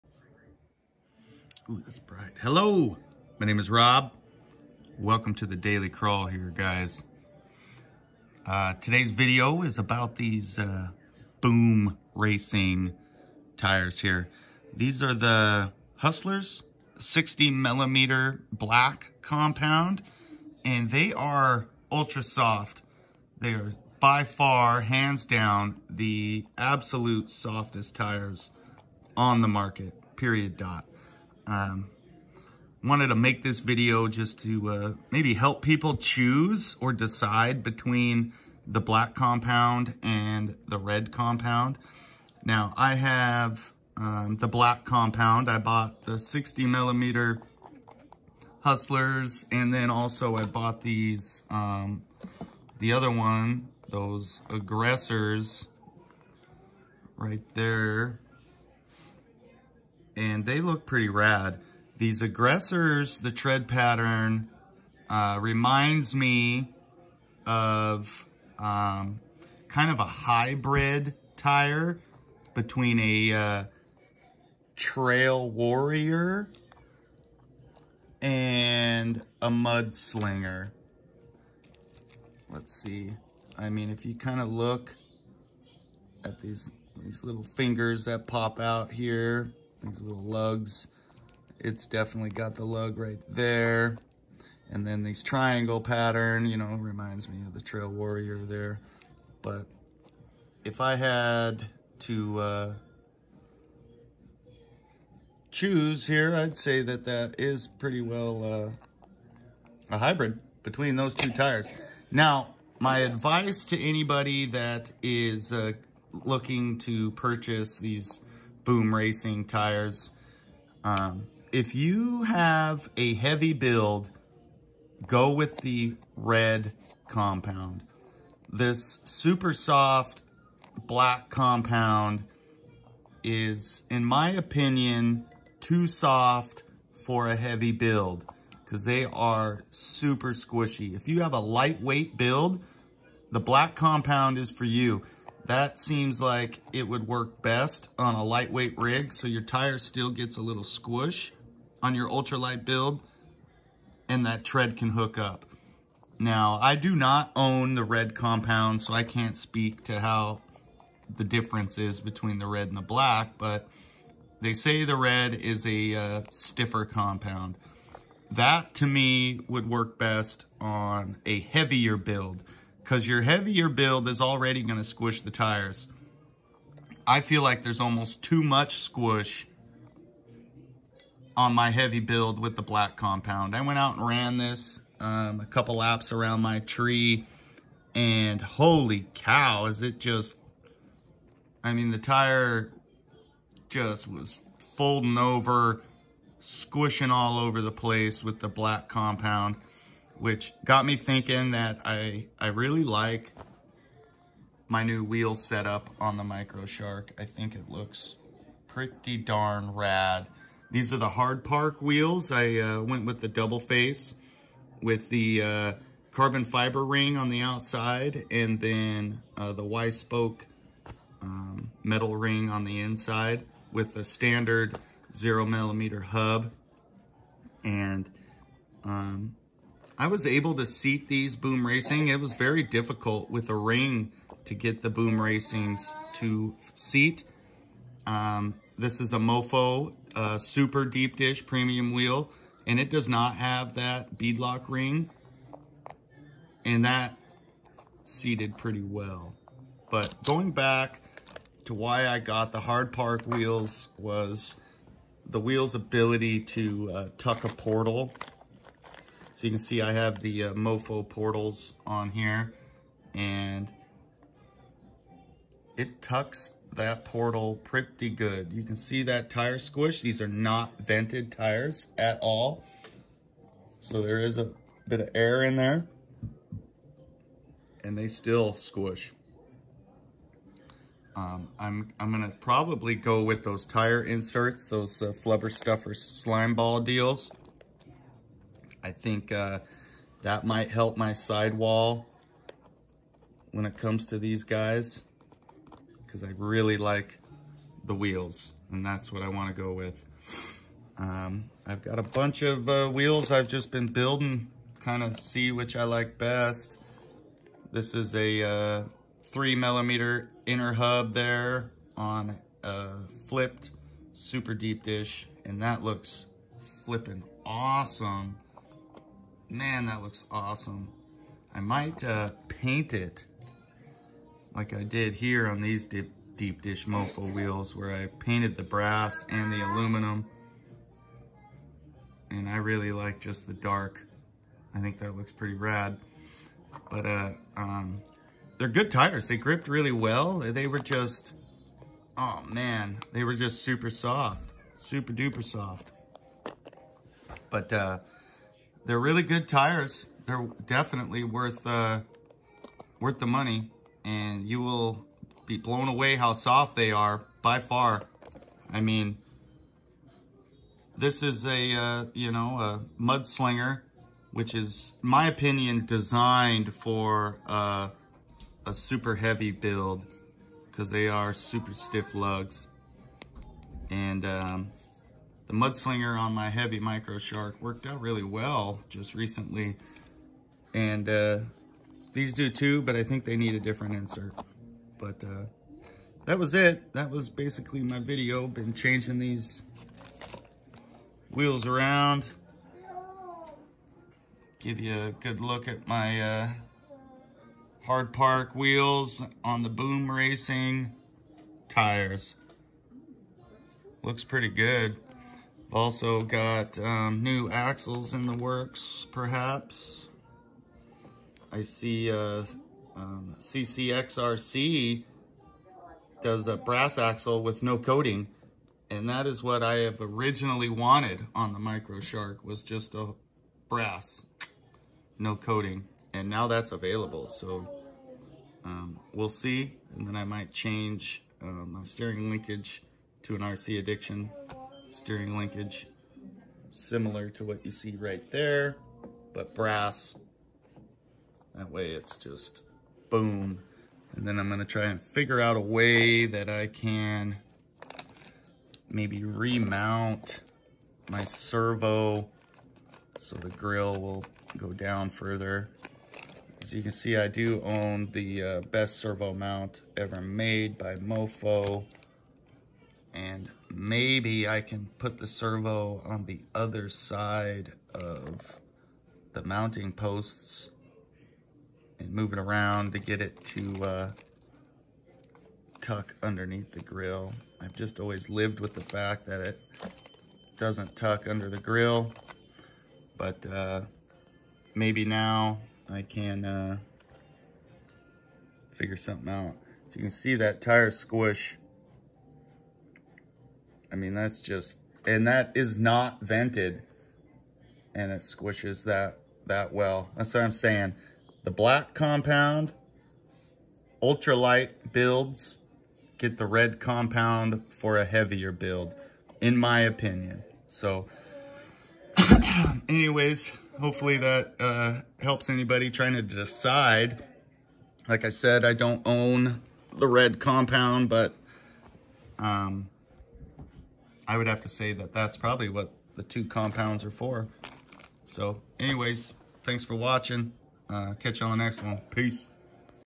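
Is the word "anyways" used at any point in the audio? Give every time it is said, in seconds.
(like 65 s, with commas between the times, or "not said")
512 s, 528 s.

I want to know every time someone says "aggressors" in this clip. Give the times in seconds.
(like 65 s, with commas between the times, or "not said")
54 s, 62 s.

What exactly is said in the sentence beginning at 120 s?
Um, if you have a heavy build, go with the red compound.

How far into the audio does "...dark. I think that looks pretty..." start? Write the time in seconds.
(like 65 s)
333 s.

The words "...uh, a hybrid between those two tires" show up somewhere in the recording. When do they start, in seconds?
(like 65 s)
108 s.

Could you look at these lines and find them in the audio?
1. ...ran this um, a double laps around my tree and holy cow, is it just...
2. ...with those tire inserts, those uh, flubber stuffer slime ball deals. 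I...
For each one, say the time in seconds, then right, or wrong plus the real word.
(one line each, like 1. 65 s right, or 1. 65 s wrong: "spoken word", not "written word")
1. 184 s wrong: "couple", not "double"
2. 283 s right.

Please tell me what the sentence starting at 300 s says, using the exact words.
Um, I've got a bunch of uh, wheels I've just been building, kind of see which I like best.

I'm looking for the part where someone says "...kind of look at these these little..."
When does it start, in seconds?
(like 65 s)
84 s.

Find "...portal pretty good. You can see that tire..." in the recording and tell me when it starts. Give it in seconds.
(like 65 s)
267 s.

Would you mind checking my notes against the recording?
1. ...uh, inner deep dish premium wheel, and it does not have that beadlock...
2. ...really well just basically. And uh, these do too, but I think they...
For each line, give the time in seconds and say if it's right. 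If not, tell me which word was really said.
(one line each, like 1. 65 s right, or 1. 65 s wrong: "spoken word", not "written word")
1. 240 s wrong: "super", not "inner"
2. 377 s wrong: "recently", not "basically".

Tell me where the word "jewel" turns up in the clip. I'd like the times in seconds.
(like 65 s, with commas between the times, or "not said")
not said.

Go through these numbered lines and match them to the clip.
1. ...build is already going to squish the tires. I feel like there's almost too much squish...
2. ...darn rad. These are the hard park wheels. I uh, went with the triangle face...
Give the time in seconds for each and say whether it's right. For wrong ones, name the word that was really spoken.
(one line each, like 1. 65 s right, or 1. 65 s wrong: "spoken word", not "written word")
1. 173 s right
2. 209 s wrong: "double", not "triangle".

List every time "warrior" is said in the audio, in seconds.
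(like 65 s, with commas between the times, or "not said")
75 s, 97 s.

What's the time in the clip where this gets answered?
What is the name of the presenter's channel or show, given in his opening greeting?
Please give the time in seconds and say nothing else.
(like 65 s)
5 s.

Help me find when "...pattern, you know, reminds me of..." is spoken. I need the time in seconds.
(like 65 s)
95 s.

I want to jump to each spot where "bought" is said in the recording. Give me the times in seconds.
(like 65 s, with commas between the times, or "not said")
45 s, 50 s.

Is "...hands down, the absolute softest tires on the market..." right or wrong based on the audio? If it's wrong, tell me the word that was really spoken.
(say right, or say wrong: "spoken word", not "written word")
right.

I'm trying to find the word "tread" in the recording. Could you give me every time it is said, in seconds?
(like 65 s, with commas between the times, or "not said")
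63 s, 154 s.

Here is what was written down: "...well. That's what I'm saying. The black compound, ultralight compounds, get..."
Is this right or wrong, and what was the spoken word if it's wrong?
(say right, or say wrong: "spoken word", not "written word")
wrong: "builds", not "compounds".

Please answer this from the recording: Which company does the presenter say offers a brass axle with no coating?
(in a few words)
CCXRC.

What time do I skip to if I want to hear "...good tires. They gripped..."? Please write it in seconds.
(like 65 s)
338 s.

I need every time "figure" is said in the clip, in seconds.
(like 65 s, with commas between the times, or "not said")
445 s, 488 s.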